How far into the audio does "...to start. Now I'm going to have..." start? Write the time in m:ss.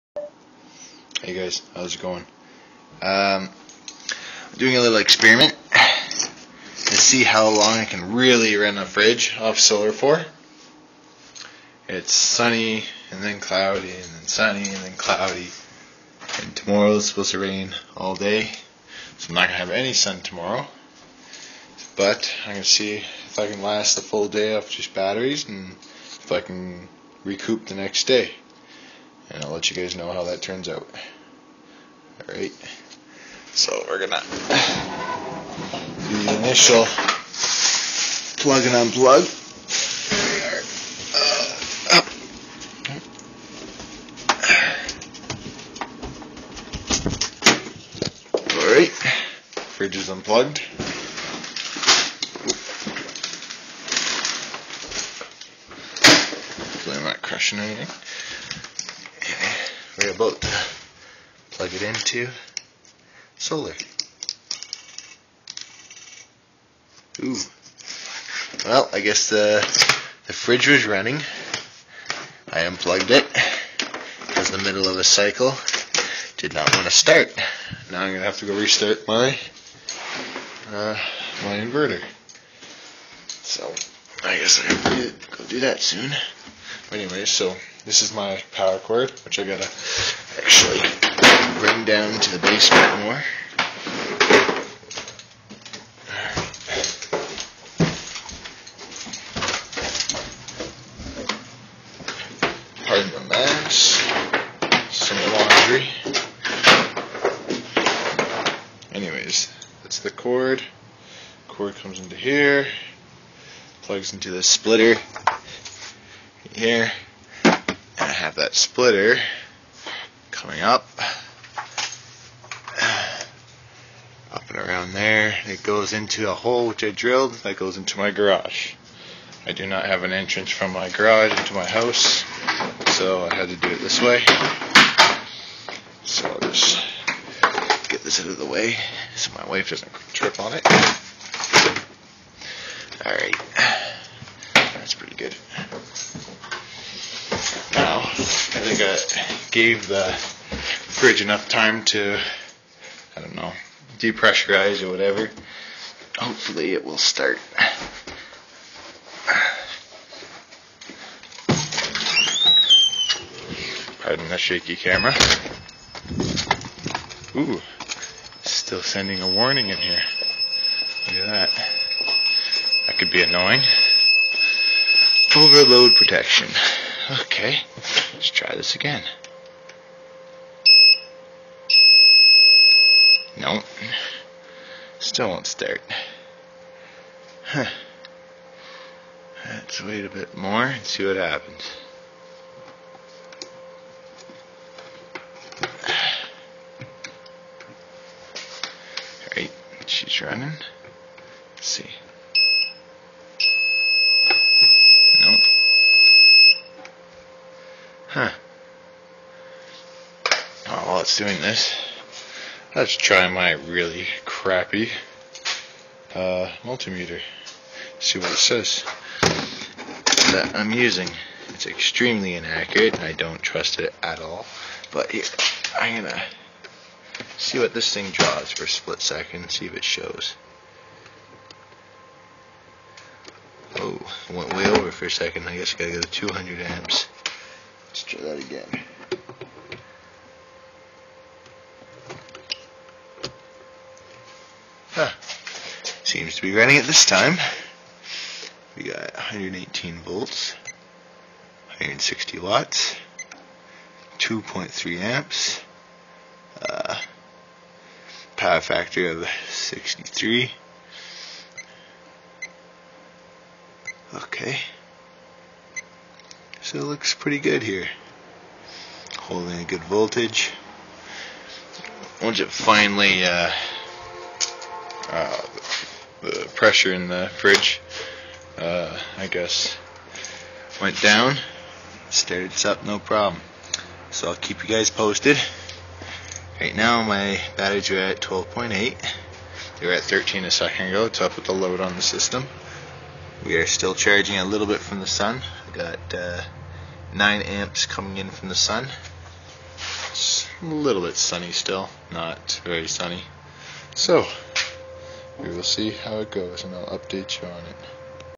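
1:16.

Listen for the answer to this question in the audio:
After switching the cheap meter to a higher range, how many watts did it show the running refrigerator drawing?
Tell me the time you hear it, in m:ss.
4:11.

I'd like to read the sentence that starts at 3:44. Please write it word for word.
But here, I'm gonna see what this thing draws for a split second.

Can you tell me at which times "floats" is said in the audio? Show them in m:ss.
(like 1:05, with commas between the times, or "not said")
not said.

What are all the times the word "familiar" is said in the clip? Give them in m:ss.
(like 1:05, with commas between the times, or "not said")
not said.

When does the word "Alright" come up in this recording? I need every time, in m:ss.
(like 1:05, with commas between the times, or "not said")
0:32, 0:48, 2:23, 3:19.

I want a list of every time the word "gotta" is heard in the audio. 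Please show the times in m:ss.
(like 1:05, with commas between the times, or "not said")
1:29, 3:55.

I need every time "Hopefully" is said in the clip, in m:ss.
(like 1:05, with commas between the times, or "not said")
0:56, 2:36.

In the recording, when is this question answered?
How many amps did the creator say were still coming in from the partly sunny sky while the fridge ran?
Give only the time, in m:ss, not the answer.
4:57.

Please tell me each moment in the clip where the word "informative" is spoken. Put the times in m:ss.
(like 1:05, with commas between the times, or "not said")
not said.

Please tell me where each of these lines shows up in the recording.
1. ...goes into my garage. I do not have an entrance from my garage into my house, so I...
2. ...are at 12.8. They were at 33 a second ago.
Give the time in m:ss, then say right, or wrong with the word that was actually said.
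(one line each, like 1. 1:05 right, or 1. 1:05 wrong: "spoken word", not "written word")
1. 2:07 right
2. 4:47 wrong: "13", not "33".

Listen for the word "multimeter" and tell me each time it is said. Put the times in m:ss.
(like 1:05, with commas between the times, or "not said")
3:36.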